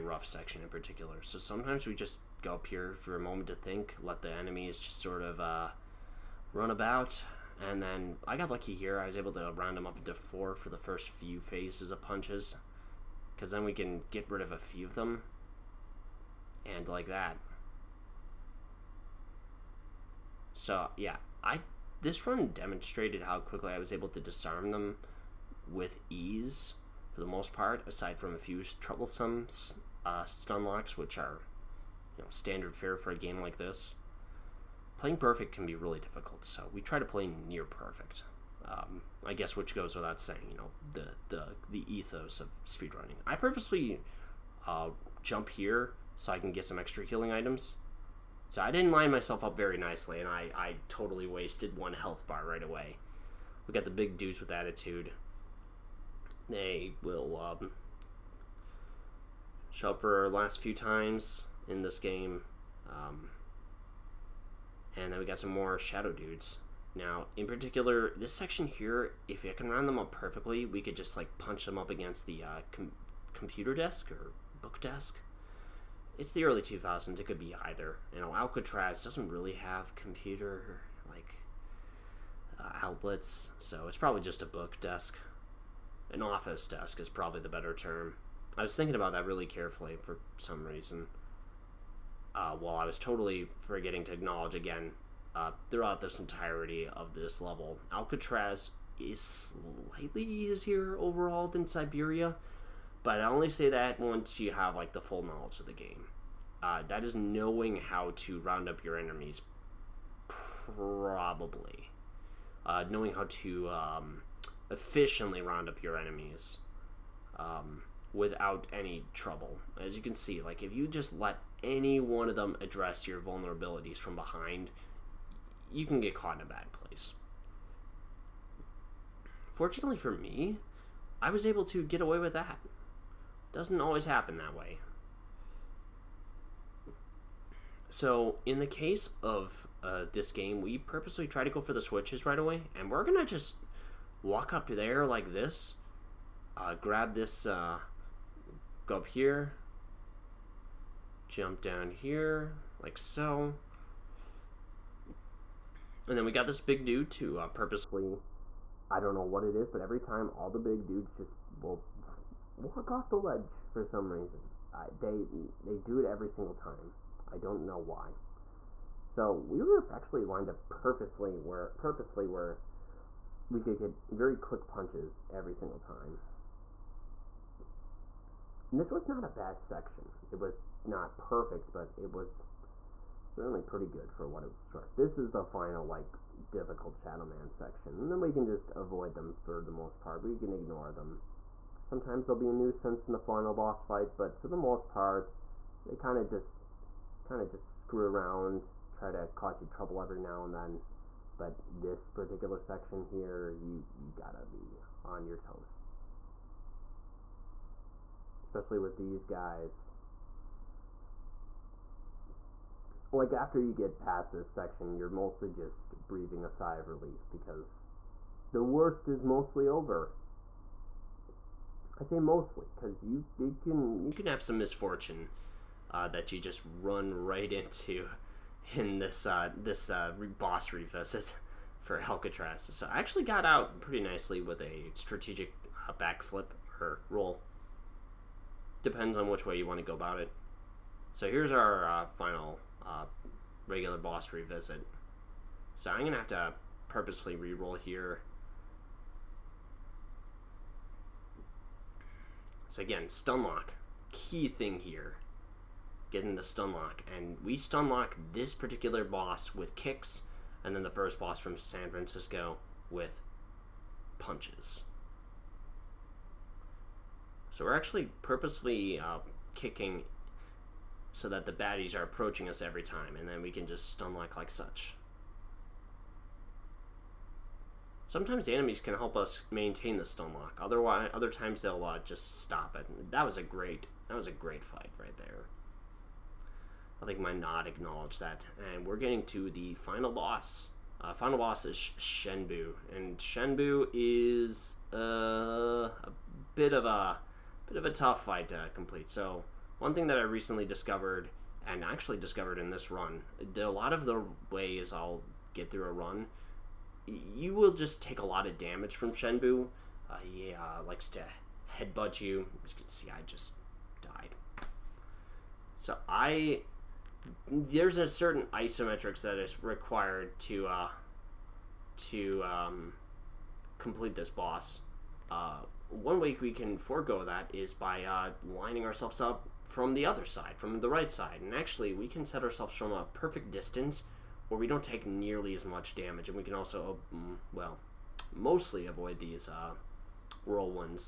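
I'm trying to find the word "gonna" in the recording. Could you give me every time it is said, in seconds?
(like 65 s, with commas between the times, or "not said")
143 s, 246 s.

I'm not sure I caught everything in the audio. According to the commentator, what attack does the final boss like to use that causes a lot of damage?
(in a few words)
Headbutt.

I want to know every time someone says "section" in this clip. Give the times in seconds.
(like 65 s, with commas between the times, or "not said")
0 s, 68 s, 179 s, 187 s, 202 s, 214 s.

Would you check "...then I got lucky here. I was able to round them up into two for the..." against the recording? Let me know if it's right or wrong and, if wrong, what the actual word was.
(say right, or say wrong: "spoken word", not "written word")
wrong: "four", not "two".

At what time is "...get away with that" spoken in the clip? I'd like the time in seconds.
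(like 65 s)
131 s.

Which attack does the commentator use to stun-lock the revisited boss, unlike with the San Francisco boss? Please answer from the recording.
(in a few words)
Kicks.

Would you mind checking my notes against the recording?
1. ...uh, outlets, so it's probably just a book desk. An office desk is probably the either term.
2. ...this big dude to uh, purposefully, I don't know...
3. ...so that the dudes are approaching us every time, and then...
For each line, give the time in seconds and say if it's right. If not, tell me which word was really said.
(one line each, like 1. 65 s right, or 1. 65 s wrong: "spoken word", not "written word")
1. 82 s wrong: "better", not "either"
2. 156 s right
3. 271 s wrong: "baddies", not "dudes".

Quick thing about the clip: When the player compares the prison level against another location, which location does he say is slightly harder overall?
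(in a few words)
Siberia.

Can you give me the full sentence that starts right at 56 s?
They will um, show up for our last few times in this game.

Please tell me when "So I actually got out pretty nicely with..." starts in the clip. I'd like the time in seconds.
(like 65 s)
232 s.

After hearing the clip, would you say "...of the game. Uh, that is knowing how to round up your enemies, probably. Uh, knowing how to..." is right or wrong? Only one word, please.
right.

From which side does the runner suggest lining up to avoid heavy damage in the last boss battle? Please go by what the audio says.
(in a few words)
The right side.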